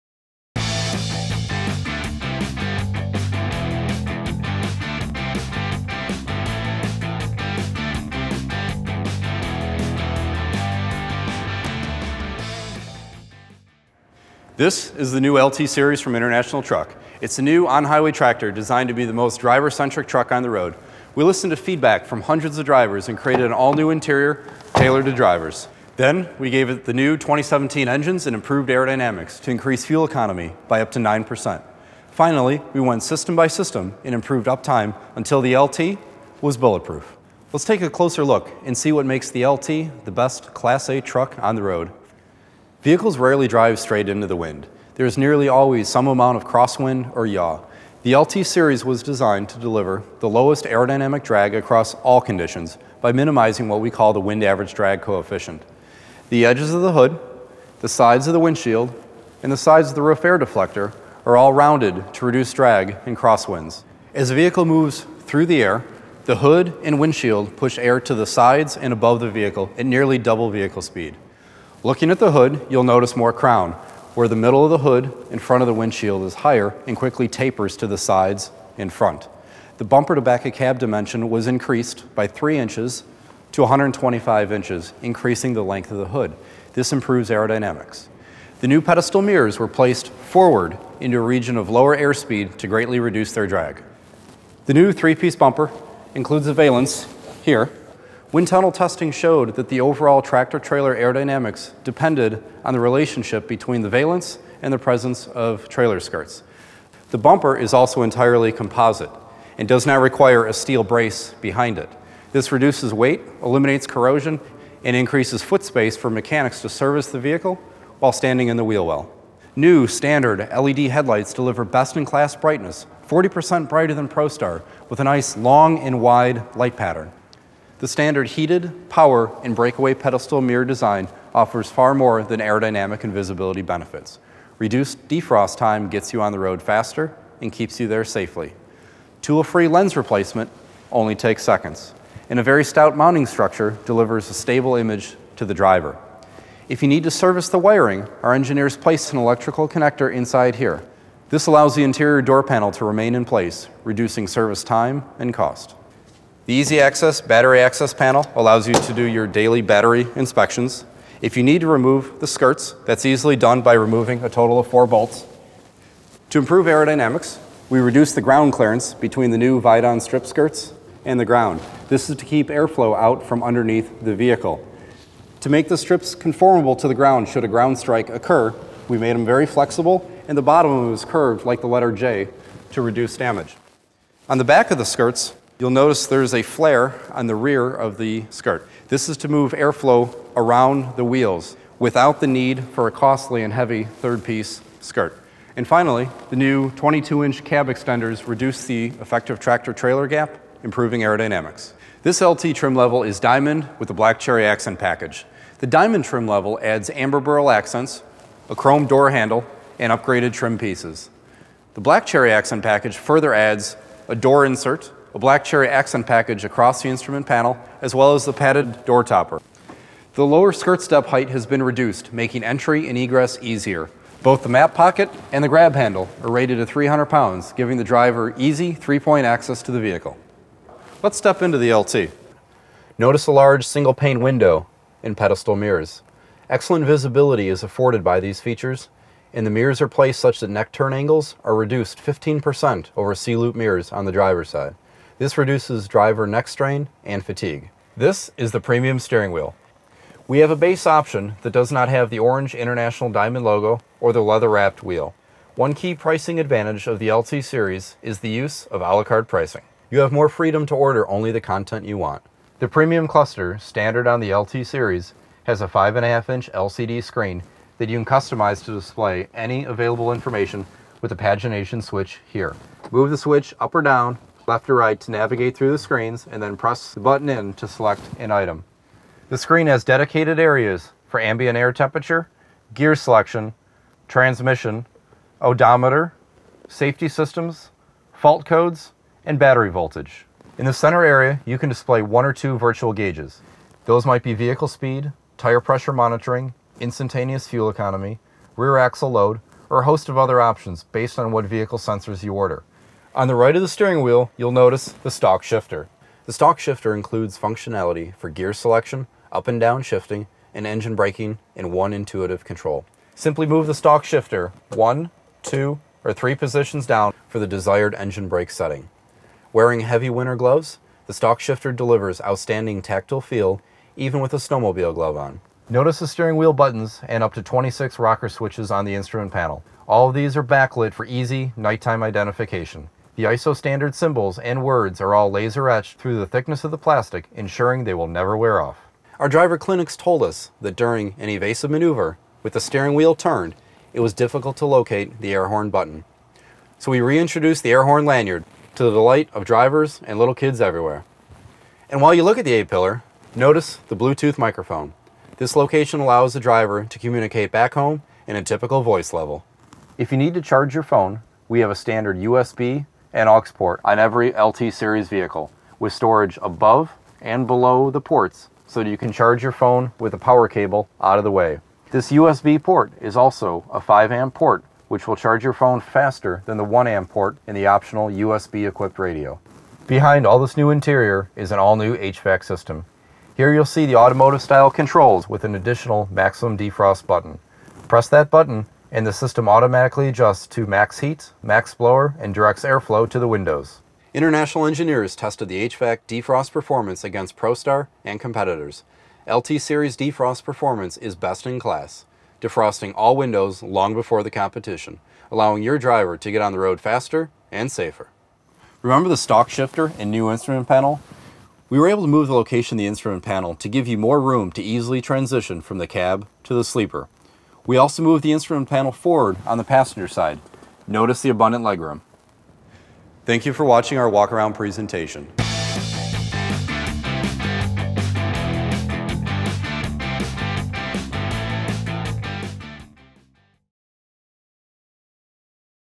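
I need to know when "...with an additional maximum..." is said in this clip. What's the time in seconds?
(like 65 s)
385 s.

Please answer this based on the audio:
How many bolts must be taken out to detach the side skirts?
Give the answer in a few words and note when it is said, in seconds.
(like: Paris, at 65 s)
4, at 164 s.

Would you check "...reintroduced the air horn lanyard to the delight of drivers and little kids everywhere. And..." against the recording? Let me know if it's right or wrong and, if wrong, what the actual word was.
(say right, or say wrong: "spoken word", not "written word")
right.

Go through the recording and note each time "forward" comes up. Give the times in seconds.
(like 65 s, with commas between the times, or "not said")
90 s, 418 s.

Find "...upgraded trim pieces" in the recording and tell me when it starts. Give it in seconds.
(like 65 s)
209 s.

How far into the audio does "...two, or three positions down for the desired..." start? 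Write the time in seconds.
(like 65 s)
315 s.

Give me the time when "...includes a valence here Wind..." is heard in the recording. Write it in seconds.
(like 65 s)
96 s.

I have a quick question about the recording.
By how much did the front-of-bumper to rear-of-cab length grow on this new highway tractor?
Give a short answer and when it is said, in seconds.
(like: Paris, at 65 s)
3 inches, at 82 s.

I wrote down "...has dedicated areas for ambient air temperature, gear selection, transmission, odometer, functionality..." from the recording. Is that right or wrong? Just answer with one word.
wrong.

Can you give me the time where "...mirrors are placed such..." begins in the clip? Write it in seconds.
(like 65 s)
239 s.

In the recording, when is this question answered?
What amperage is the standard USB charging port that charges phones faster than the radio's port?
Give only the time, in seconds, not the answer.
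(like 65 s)
373 s.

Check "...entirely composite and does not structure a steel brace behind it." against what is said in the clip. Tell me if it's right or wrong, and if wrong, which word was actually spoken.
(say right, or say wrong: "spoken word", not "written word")
wrong: "require", not "structure".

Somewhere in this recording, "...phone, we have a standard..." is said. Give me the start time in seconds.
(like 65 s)
360 s.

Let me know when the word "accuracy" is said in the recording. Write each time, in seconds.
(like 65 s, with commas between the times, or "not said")
not said.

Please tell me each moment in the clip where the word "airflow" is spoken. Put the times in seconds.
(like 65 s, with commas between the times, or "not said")
172 s, 189 s, 392 s.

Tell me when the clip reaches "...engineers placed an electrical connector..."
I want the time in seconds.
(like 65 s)
148 s.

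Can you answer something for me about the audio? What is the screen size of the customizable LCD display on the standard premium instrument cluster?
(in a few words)
5.5 inch.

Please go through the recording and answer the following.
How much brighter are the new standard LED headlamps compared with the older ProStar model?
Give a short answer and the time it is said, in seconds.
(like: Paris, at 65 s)
40%, at 123 s.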